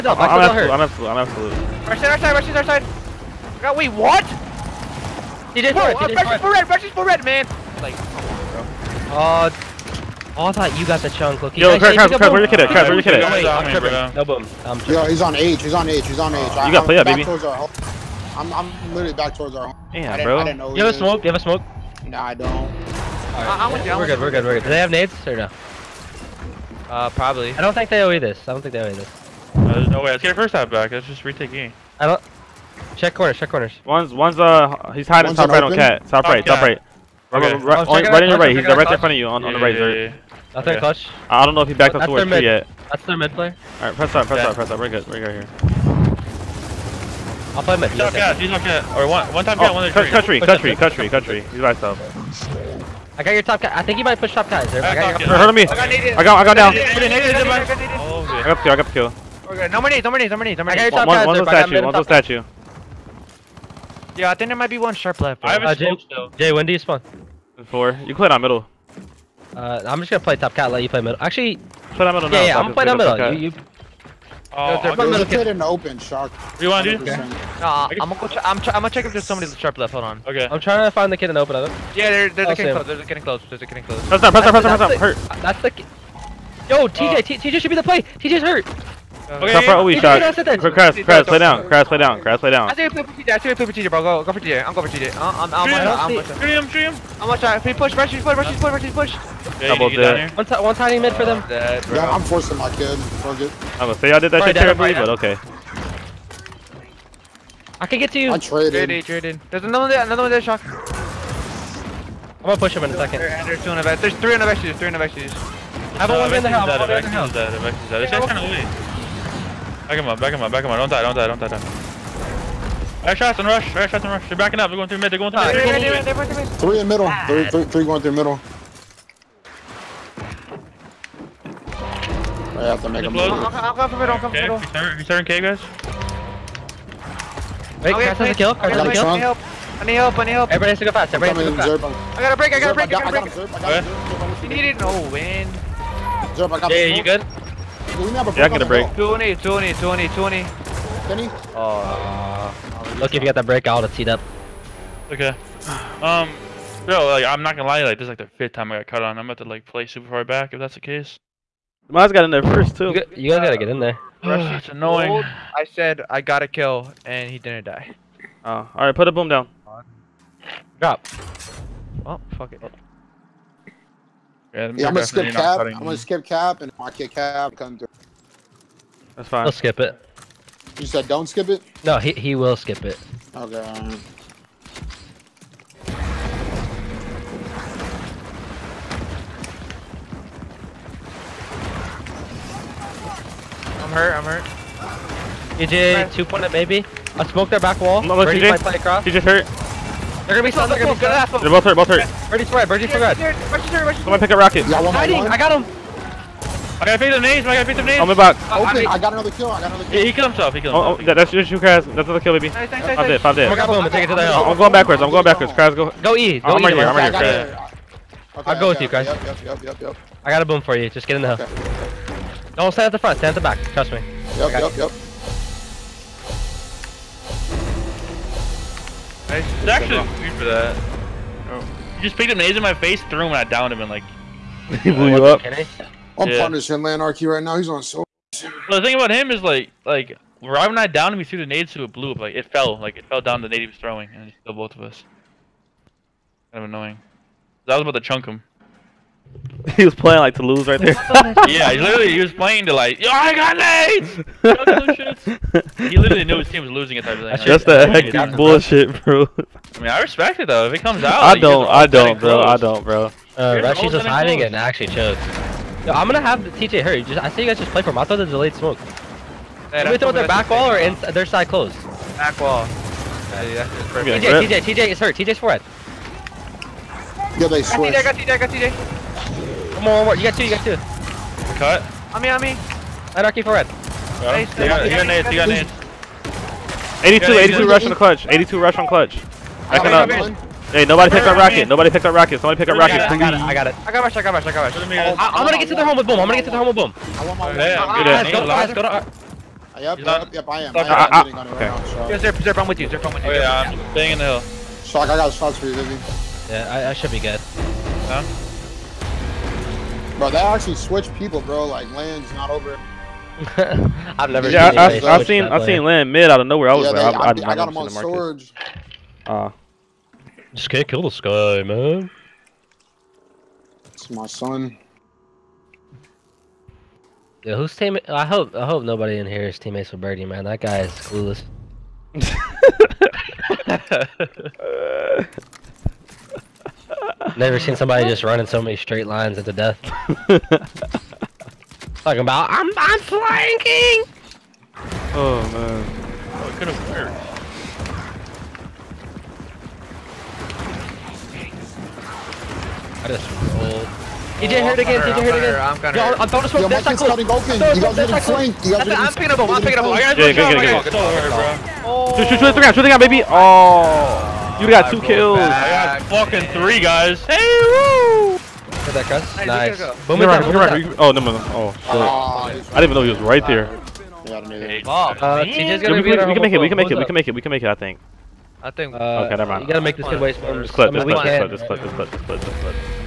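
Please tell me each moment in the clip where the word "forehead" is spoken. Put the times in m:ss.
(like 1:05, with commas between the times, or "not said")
4:35.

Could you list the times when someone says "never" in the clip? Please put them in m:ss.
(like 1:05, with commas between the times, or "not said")
5:14, 5:37, 6:19.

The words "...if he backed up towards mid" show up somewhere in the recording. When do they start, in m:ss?
0:41.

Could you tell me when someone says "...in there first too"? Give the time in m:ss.
2:42.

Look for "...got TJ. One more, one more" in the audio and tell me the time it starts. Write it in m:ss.
4:38.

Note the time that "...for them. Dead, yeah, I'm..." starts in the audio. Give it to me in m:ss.
1:41.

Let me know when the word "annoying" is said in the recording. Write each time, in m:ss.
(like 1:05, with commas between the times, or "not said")
2:44, 4:06.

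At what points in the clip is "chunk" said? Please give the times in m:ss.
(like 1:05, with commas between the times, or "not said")
0:11, 4:08.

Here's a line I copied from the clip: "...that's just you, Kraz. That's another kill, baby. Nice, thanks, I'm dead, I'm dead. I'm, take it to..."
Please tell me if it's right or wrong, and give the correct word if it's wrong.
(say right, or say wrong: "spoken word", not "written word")
right.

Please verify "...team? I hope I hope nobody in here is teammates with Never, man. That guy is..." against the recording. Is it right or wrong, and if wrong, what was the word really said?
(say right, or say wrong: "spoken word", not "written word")
wrong: "Birdie", not "Never".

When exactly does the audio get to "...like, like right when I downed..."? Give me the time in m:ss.
3:59.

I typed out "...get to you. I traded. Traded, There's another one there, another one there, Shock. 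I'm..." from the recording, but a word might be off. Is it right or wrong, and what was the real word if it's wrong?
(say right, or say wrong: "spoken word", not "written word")
right.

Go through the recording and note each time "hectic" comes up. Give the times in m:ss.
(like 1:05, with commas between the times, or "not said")
4:17.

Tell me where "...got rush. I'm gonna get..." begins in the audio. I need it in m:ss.
4:54.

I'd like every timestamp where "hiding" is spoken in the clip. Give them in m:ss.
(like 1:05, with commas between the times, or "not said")
0:35, 3:24, 4:24.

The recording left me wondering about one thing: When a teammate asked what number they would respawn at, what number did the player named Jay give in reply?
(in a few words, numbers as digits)
4.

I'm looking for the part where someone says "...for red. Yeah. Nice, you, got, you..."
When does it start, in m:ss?
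4:43.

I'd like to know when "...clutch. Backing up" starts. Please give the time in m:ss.
4:48.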